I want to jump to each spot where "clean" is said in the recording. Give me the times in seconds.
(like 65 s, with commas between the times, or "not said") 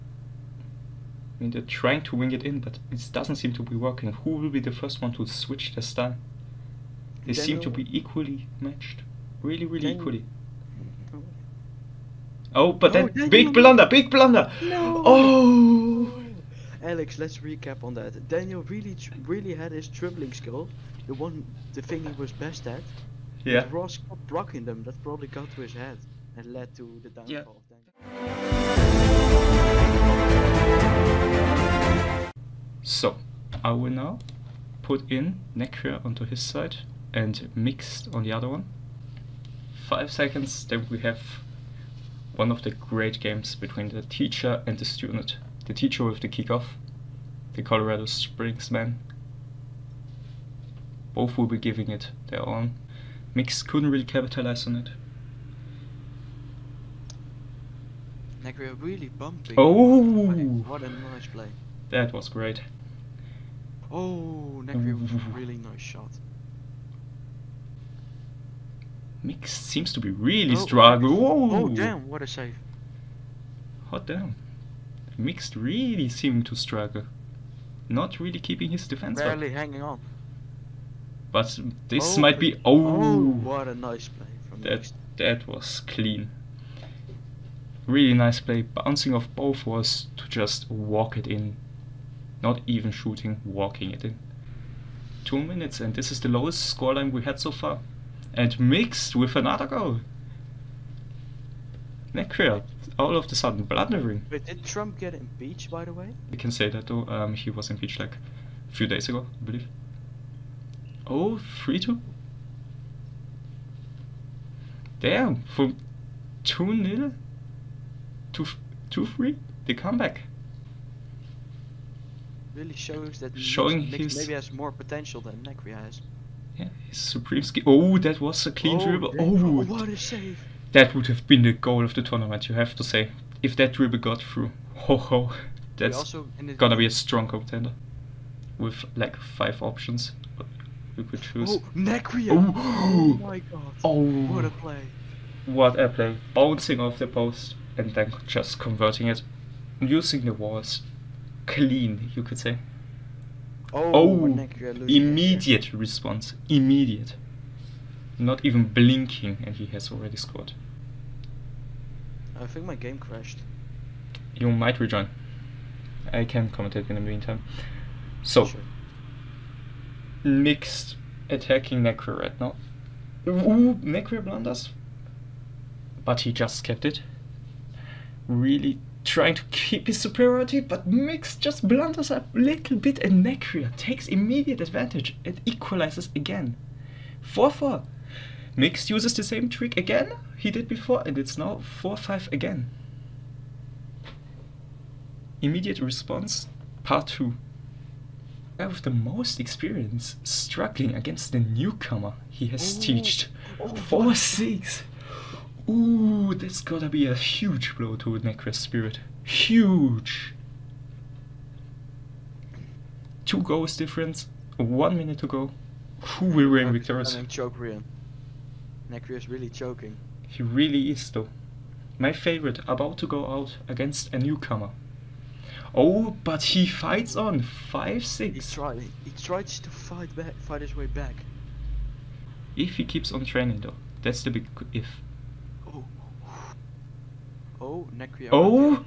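85 s, 128 s, 151 s.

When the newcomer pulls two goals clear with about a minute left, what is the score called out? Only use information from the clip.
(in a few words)
4-6.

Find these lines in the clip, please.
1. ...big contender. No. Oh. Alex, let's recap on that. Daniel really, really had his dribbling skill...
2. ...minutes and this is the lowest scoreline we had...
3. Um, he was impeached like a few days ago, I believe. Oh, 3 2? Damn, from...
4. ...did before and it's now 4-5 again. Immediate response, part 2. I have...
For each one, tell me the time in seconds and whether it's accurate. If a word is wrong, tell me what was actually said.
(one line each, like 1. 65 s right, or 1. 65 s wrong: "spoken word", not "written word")
1. 13 s wrong: "blunder", not "contender"
2. 95 s right
3. 107 s right
4. 190 s right.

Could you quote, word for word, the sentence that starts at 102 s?
Necria, all of a sudden, blundering.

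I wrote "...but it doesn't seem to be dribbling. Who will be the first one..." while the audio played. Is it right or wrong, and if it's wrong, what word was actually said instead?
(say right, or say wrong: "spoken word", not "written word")
wrong: "working", not "dribbling".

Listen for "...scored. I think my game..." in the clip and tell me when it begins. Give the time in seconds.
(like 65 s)
160 s.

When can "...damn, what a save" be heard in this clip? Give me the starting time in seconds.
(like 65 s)
71 s.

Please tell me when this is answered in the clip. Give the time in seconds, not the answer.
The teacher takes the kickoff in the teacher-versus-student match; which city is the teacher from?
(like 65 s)
47 s.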